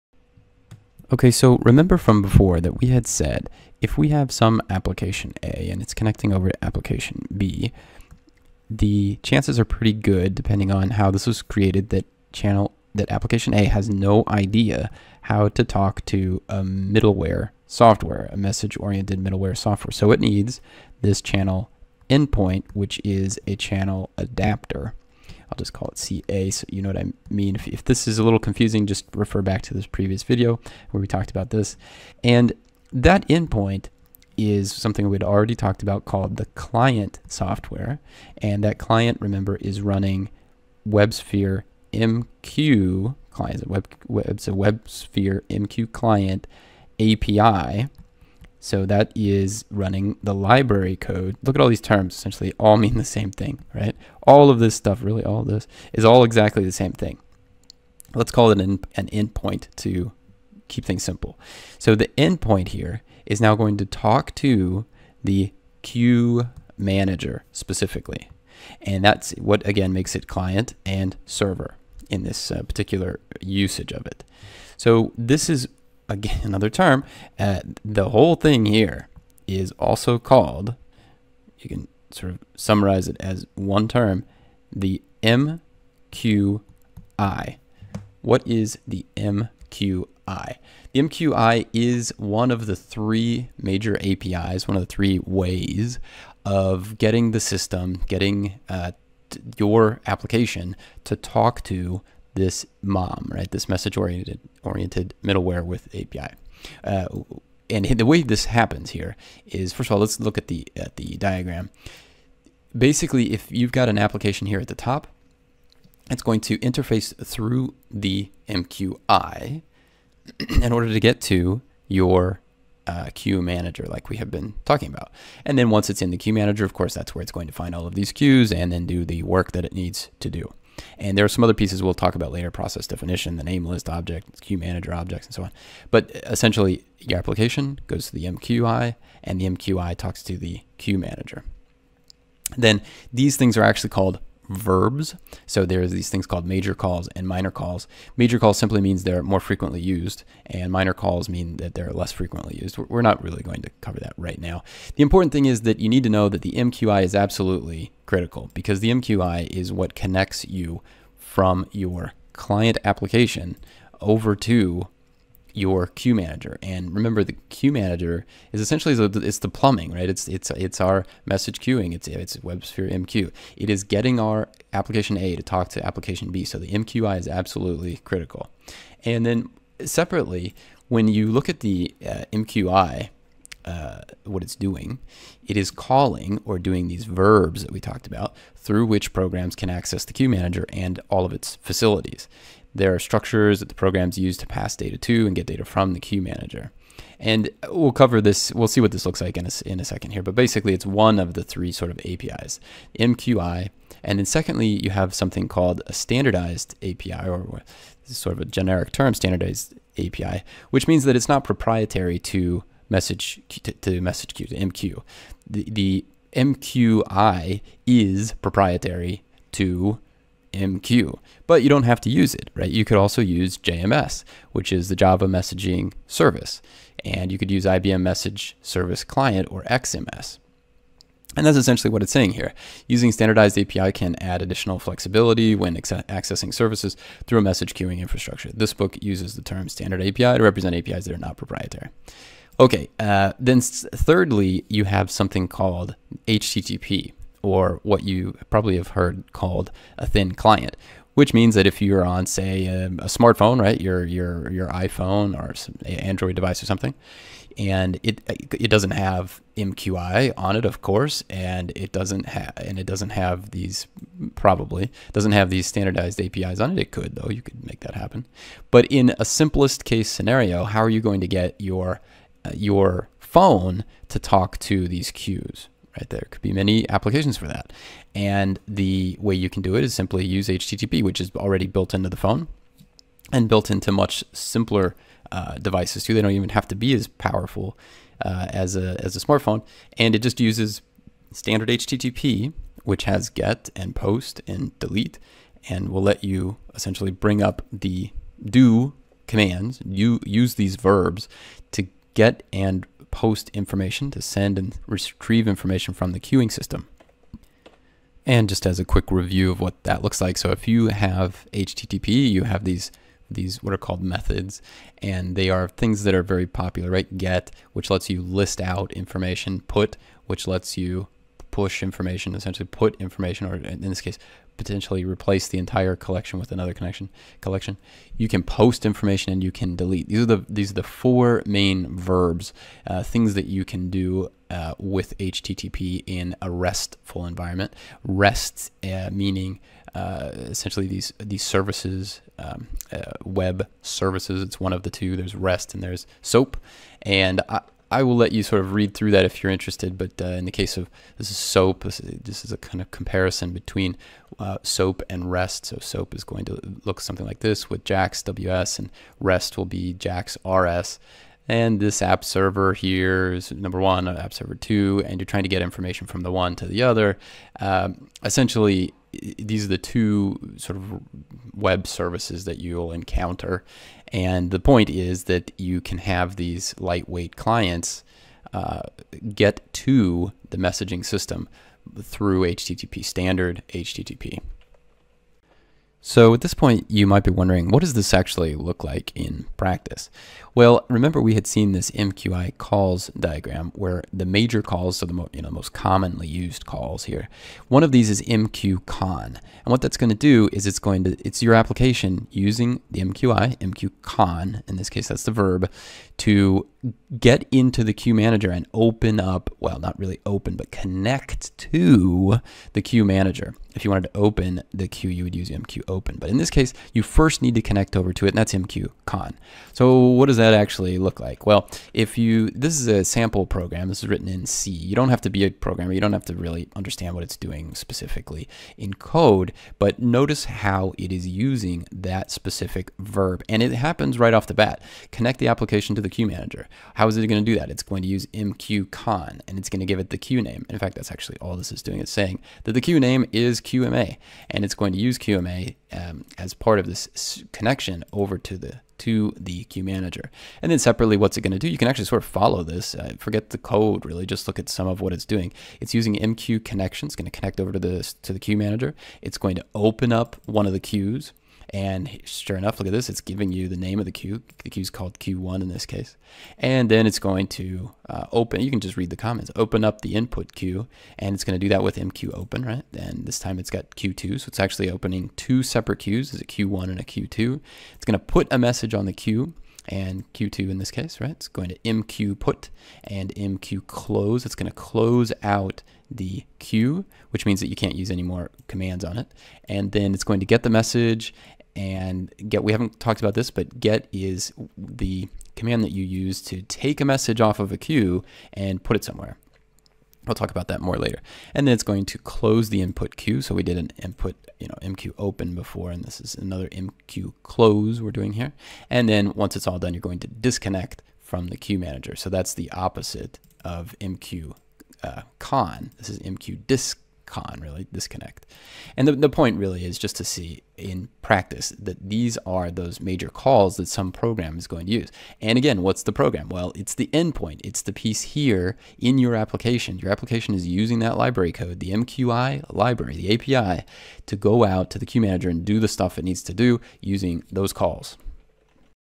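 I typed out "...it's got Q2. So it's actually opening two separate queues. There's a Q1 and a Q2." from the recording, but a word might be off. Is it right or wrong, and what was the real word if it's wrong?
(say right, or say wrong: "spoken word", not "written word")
right.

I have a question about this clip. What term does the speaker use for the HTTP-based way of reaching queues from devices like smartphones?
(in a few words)
thin client.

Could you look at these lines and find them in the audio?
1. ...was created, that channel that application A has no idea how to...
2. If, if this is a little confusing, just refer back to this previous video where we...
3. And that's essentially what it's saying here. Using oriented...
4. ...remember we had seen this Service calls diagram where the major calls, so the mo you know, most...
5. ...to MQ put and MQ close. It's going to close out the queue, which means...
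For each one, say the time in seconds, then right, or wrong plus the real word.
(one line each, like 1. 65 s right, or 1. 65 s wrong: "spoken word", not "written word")
1. 11 s right
2. 27 s right
3. 231 s wrong: "standardized", not "oriented"
4. 390 s wrong: "MQI", not "Service"
5. 481 s right.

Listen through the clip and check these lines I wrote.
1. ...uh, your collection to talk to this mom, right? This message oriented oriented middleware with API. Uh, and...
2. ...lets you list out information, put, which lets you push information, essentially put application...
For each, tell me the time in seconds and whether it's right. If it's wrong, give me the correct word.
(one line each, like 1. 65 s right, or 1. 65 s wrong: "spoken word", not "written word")
1. 98 s wrong: "application", not "collection"
2. 317 s wrong: "information", not "application".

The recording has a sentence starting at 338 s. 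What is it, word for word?
REST uh, meaning uh, essentially these these services, um, uh, web services.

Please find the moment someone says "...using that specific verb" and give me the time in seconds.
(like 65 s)
431 s.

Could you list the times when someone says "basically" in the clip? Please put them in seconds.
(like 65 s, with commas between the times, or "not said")
112 s, 200 s.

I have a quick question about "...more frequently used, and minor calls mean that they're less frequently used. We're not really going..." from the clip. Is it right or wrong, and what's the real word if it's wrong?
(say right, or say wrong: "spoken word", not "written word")
right.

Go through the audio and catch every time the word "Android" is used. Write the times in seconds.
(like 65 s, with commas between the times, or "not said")
255 s.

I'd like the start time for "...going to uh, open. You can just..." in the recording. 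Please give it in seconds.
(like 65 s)
467 s.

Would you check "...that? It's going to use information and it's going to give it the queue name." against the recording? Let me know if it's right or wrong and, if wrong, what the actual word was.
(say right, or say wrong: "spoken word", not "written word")
wrong: "mqcon", not "information".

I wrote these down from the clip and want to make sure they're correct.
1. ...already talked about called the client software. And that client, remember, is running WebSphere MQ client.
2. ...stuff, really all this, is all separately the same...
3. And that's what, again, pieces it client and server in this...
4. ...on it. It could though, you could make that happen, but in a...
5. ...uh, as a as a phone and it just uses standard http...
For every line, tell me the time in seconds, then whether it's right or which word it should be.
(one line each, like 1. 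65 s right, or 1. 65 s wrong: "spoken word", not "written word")
1. 35 s right
2. 54 s wrong: "exactly", not "separately"
3. 68 s wrong: "makes", not "pieces"
4. 266 s right
5. 288 s wrong: "smartphone", not "phone".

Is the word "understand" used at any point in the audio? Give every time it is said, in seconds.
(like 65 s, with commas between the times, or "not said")
426 s.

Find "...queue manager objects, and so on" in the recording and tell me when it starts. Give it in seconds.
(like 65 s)
134 s.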